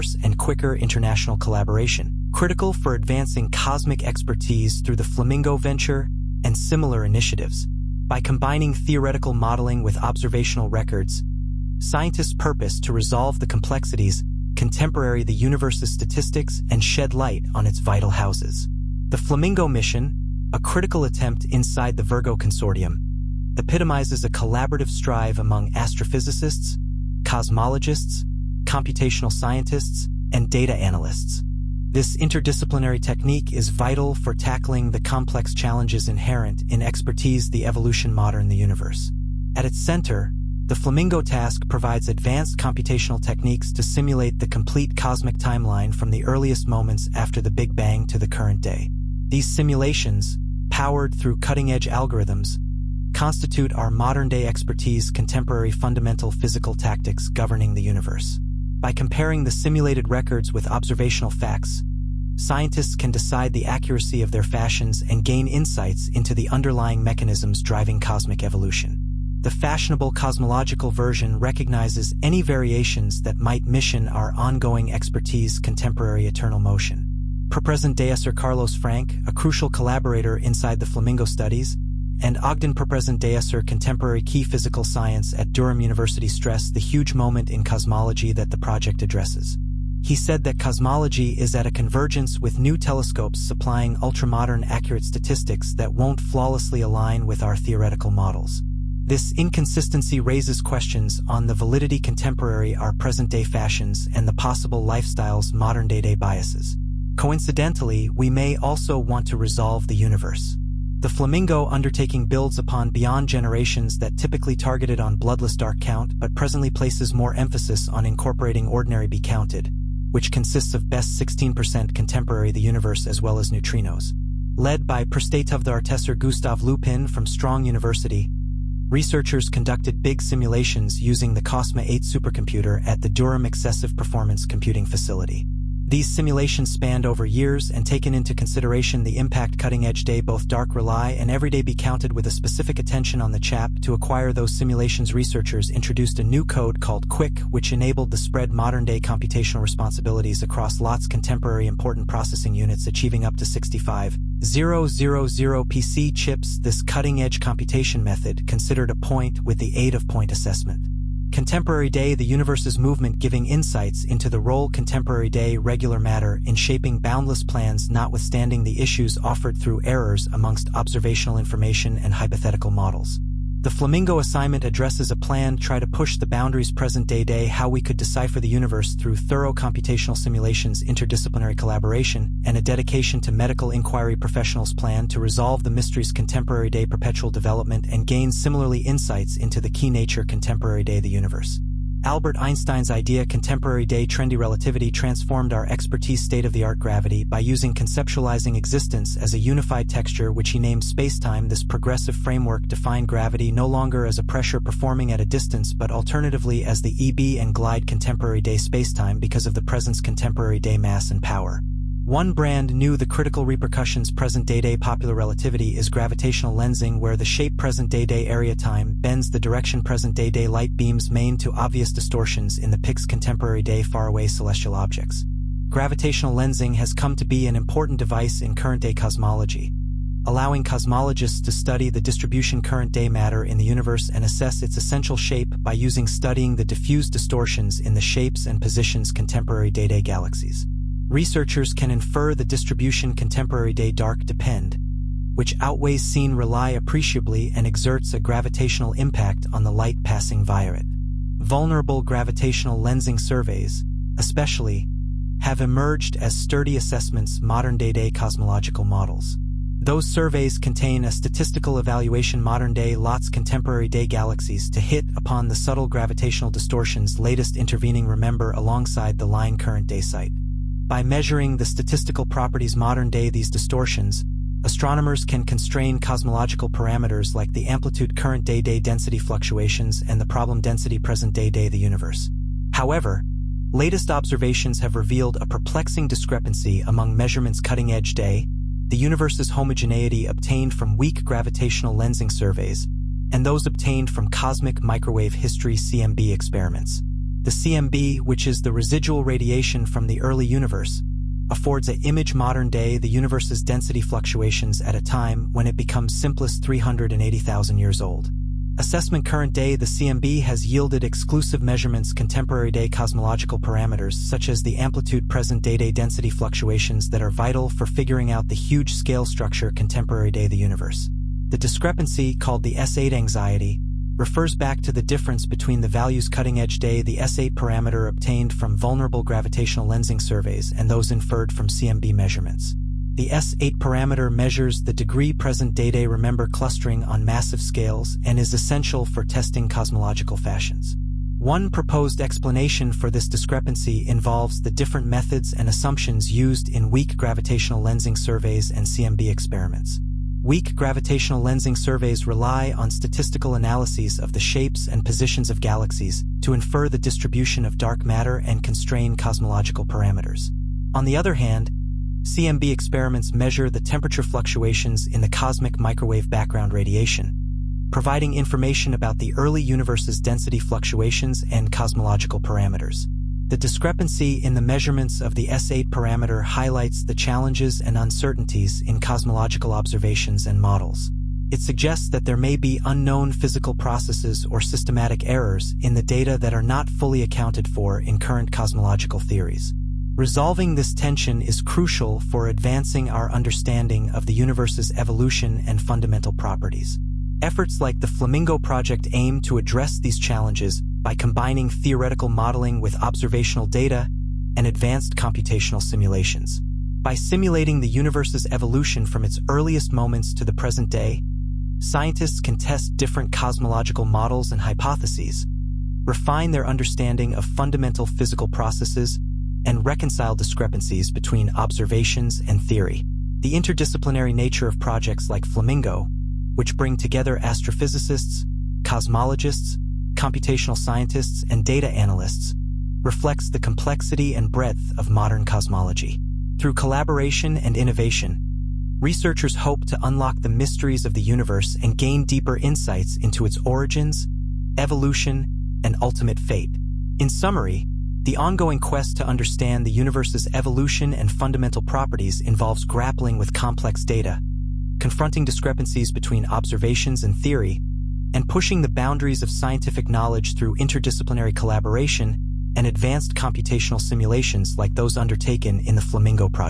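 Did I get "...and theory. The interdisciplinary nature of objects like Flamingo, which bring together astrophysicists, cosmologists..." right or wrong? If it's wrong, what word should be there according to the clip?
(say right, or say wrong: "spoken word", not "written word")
wrong: "projects", not "objects".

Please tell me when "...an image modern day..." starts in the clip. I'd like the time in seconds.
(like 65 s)
301 s.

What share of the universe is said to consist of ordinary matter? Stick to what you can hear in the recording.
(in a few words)
16%.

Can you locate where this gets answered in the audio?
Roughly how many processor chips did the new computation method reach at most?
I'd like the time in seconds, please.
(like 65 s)
153 s.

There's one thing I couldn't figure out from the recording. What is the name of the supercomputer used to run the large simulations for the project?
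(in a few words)
COSMA-8.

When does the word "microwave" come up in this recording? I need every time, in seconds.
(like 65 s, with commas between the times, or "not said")
294 s, 365 s.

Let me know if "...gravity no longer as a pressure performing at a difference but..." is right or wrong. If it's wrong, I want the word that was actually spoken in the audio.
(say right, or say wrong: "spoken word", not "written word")
wrong: "distance", not "difference".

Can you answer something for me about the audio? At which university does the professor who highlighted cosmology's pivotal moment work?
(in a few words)
Durham University.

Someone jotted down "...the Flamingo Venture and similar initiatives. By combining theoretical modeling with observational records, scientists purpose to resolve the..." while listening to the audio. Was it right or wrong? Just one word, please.
right.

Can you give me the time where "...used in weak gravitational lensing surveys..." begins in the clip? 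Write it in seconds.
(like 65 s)
346 s.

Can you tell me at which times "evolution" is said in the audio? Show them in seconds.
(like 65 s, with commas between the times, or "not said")
37 s, 68 s, 394 s, 408 s, 444 s, 450 s.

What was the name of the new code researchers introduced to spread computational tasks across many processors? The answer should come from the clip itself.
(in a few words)
QUIC.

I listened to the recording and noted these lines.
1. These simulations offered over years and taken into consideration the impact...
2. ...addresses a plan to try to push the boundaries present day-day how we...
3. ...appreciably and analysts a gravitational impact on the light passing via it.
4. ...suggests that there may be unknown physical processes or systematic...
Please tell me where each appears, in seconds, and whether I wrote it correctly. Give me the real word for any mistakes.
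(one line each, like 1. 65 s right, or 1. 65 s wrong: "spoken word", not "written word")
1. 135 s wrong: "spanned", not "offered"
2. 174 s right
3. 246 s wrong: "exerts", not "analysts"
4. 381 s right.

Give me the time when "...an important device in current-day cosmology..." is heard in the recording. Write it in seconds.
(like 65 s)
227 s.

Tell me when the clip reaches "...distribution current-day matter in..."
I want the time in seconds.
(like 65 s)
232 s.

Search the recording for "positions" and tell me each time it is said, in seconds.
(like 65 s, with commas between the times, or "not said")
238 s, 355 s.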